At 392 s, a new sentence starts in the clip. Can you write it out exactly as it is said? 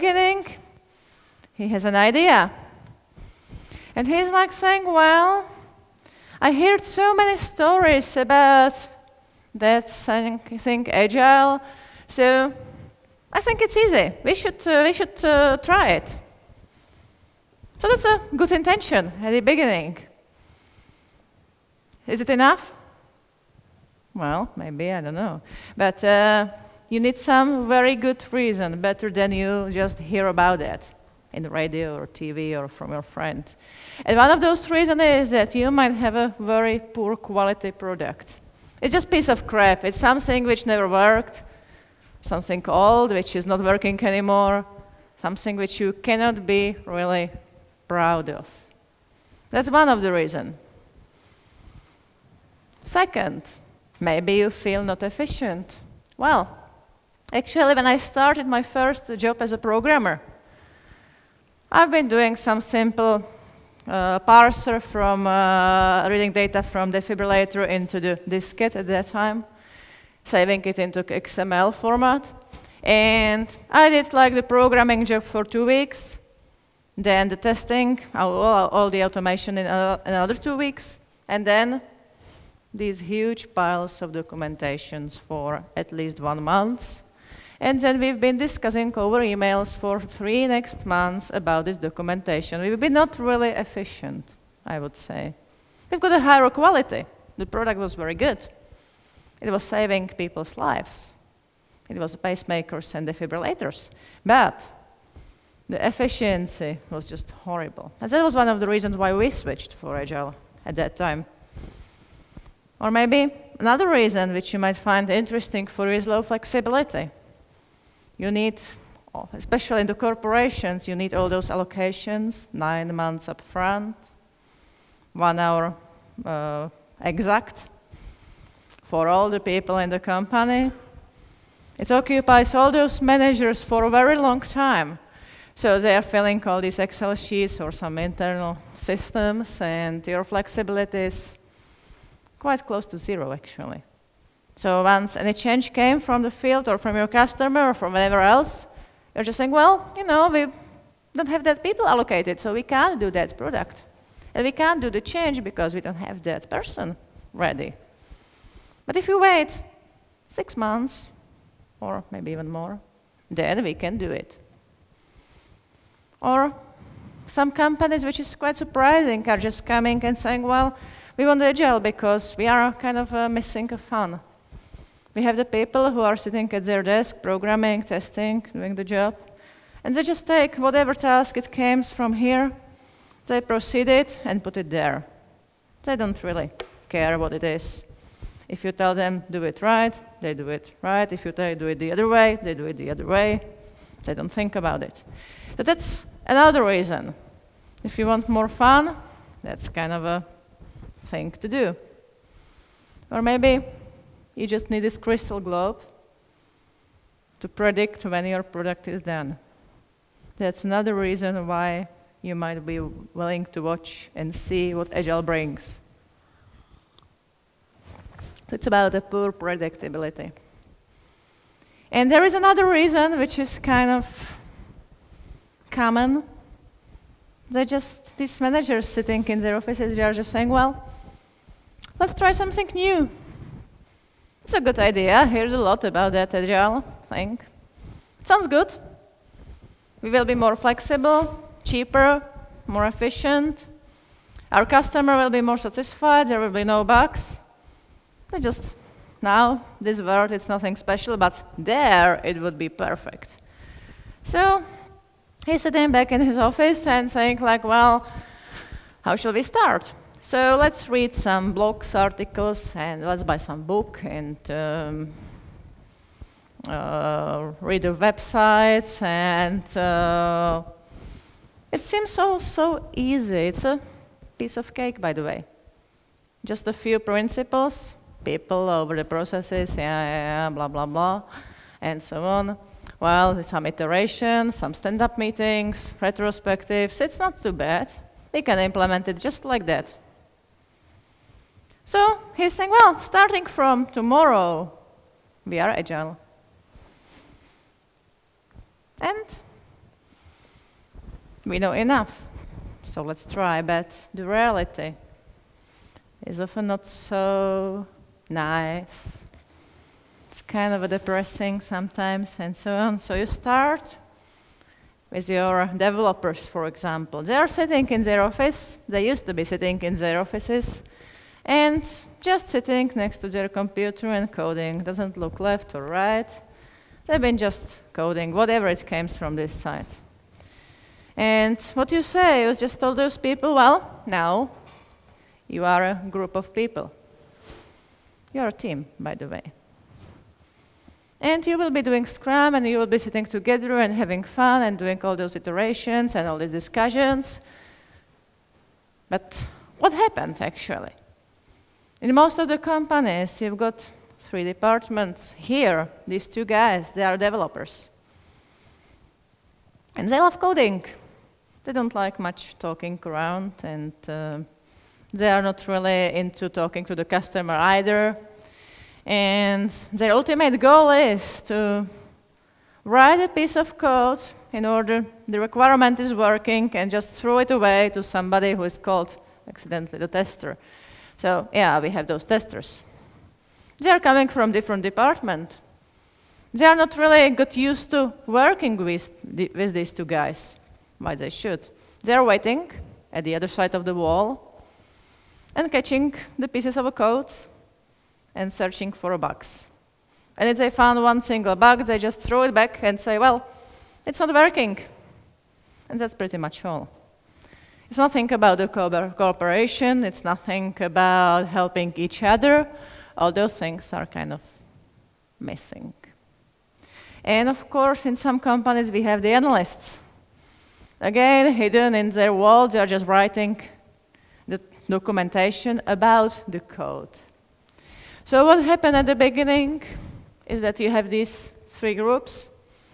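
They are waiting at the other side of the wall and catching the pieces of a code and searching for a bugs.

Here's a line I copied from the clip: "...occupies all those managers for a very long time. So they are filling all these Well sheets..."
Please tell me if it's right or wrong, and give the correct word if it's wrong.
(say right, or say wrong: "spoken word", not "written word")
wrong: "Excel", not "Well".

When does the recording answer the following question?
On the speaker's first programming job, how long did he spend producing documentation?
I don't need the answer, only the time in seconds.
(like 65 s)
86 s.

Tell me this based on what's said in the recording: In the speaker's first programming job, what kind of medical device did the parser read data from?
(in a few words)
defibrillator.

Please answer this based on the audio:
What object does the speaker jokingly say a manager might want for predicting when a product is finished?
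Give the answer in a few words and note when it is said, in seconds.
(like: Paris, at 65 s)
crystal globe, at 204 s.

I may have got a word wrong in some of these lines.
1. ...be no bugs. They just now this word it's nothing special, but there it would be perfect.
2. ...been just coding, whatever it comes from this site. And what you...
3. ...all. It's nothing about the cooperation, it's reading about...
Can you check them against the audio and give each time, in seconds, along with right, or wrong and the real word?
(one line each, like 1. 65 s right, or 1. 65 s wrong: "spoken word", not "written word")
1. 246 s right
2. 327 s right
3. 406 s wrong: "nothing", not "reading".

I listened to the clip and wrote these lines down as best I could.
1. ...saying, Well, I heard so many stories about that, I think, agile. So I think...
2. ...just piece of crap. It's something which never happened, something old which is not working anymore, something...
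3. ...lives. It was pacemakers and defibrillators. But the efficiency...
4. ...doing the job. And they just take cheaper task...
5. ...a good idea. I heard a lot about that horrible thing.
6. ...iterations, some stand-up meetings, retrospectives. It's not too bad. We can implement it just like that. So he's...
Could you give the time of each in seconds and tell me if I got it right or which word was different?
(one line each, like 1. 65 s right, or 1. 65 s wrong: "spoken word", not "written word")
1. 4 s right
2. 38 s wrong: "worked", not "happened"
3. 100 s right
4. 178 s wrong: "whatever", not "cheaper"
5. 234 s wrong: "agile", not "horrible"
6. 283 s right.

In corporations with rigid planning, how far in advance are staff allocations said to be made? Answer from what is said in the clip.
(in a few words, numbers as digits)
9 months.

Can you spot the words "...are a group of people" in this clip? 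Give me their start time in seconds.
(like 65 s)
335 s.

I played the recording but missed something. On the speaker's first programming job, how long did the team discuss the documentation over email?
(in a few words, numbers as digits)
3 months.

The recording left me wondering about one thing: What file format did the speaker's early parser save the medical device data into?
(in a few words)
XML.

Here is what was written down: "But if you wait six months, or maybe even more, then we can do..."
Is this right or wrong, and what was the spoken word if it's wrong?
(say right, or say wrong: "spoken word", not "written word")
right.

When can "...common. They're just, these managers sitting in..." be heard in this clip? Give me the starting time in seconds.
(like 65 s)
225 s.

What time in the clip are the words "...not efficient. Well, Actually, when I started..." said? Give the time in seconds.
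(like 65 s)
54 s.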